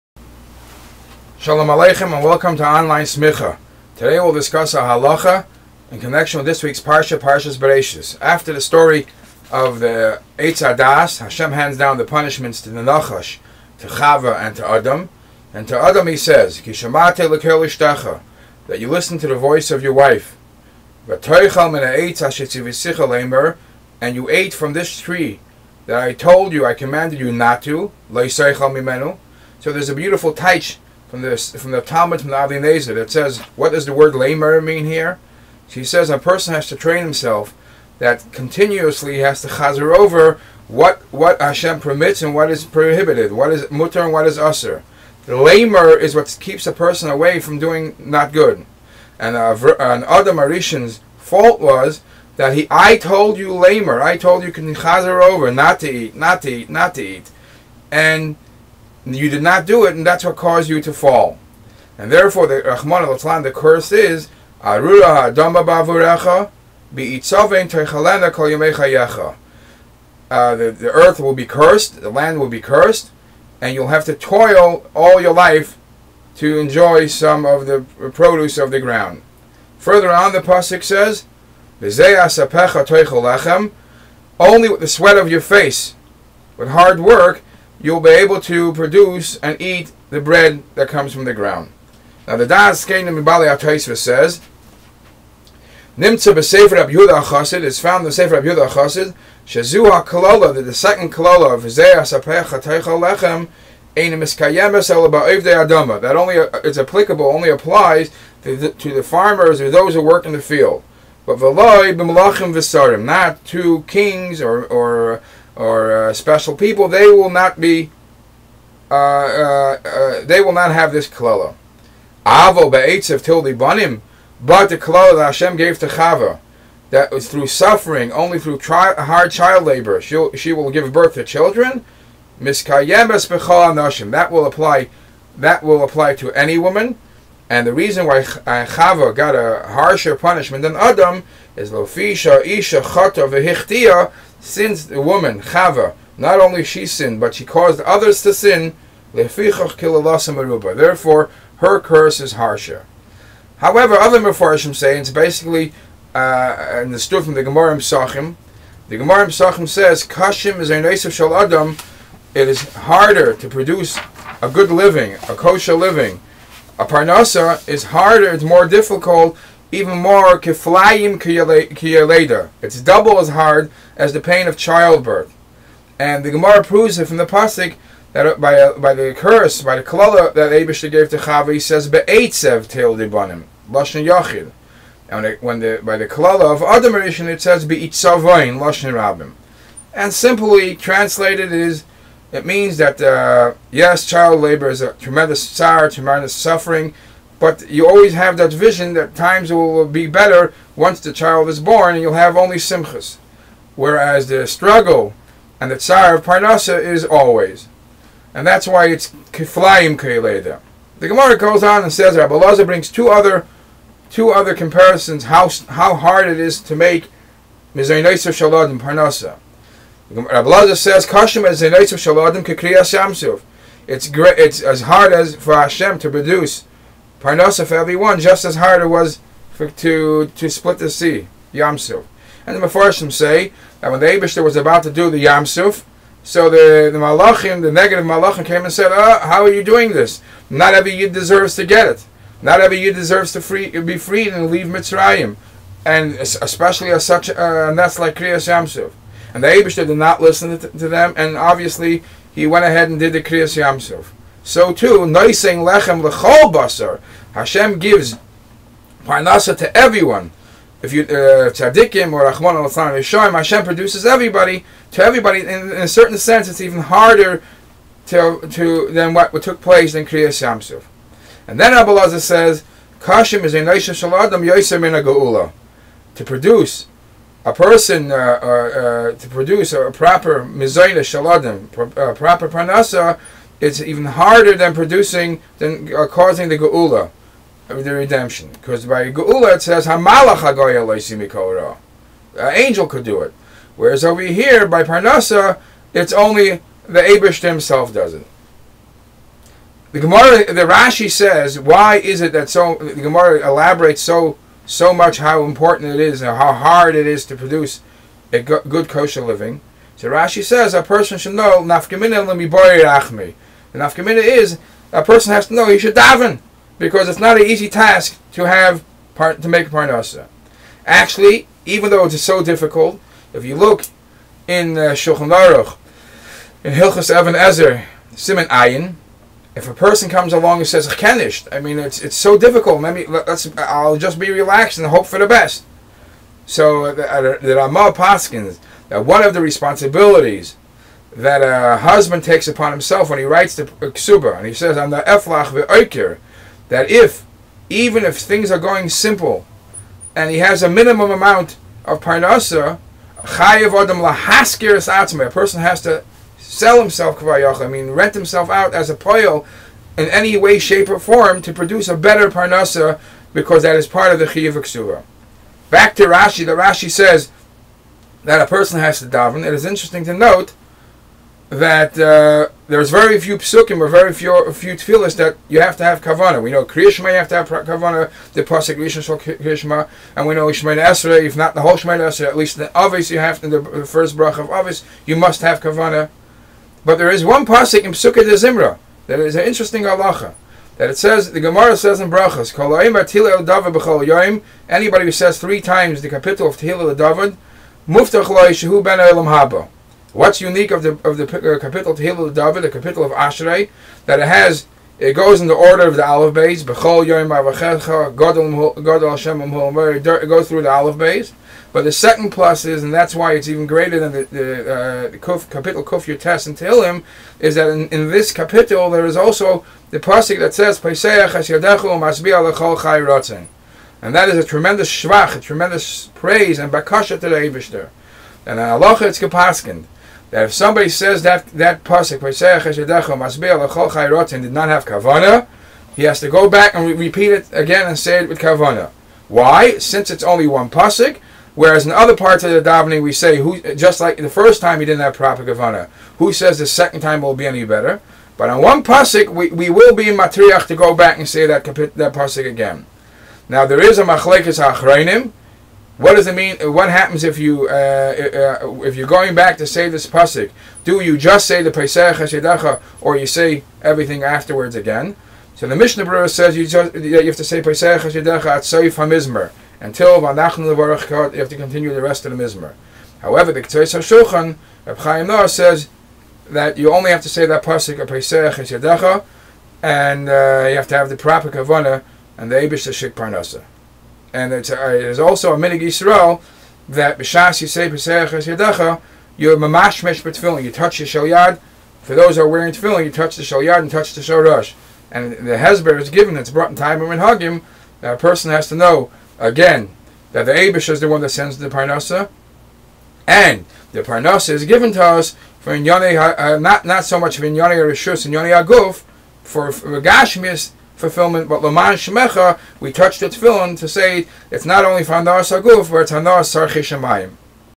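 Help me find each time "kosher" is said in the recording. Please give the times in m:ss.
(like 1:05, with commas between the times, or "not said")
2:45, 5:08.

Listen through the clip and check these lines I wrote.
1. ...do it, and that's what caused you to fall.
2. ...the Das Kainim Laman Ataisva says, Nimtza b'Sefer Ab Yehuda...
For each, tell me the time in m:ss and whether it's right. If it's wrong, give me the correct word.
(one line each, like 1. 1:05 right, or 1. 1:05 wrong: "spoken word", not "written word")
1. 0:59 right
2. 1:32 wrong: "Bali", not "Laman".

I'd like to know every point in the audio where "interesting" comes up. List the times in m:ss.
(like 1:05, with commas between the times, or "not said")
6:09, 6:29.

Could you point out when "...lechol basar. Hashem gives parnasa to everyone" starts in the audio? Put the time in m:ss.
4:16.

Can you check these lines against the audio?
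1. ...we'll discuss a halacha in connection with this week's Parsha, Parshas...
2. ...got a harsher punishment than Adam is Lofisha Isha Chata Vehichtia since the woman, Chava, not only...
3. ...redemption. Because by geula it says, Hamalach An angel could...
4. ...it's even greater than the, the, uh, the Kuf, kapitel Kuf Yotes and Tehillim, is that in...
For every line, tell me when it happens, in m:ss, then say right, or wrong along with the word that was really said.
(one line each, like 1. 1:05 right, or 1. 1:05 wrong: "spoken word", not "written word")
1. 0:04 right
2. 2:19 right
3. 4:47 right
4. 6:53 right.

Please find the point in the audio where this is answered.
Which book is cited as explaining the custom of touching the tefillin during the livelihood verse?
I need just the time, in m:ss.
8:16.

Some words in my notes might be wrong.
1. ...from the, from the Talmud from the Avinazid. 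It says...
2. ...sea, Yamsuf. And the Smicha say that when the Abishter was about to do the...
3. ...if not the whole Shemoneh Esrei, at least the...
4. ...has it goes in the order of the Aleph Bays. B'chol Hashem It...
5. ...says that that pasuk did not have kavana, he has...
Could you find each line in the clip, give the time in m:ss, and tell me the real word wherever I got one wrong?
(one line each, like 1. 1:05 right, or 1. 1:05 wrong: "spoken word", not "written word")
1. 0:31 right
2. 3:50 wrong: "Mepharshim", not "Smicha"
3. 6:21 right
4. 6:44 right
5. 7:10 right.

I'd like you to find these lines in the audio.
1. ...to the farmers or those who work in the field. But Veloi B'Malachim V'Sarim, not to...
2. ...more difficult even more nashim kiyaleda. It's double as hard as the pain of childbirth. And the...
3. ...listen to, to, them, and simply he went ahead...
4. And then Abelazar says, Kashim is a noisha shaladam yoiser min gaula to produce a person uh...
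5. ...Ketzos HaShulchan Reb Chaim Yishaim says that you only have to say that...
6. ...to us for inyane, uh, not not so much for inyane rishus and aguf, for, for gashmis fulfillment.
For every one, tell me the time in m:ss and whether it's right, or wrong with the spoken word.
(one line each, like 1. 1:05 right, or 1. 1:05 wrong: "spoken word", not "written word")
1. 1:48 right
2. 2:48 wrong: "kiflayim", not "nashim"
3. 4:10 wrong: "obviously", not "simply"
4. 4:31 right
5. 7:53 wrong: "Noah", not "Yishaim"
6. 8:24 right.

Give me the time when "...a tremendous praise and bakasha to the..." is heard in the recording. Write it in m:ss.
7:05.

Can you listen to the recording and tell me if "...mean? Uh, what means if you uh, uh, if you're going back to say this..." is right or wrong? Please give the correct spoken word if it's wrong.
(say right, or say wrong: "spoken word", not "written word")
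wrong: "happens", not "means".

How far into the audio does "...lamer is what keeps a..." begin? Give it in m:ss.
0:45.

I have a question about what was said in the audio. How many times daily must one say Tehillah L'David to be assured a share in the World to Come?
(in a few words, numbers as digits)
3.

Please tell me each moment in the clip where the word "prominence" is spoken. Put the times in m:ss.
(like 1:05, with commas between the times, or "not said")
not said.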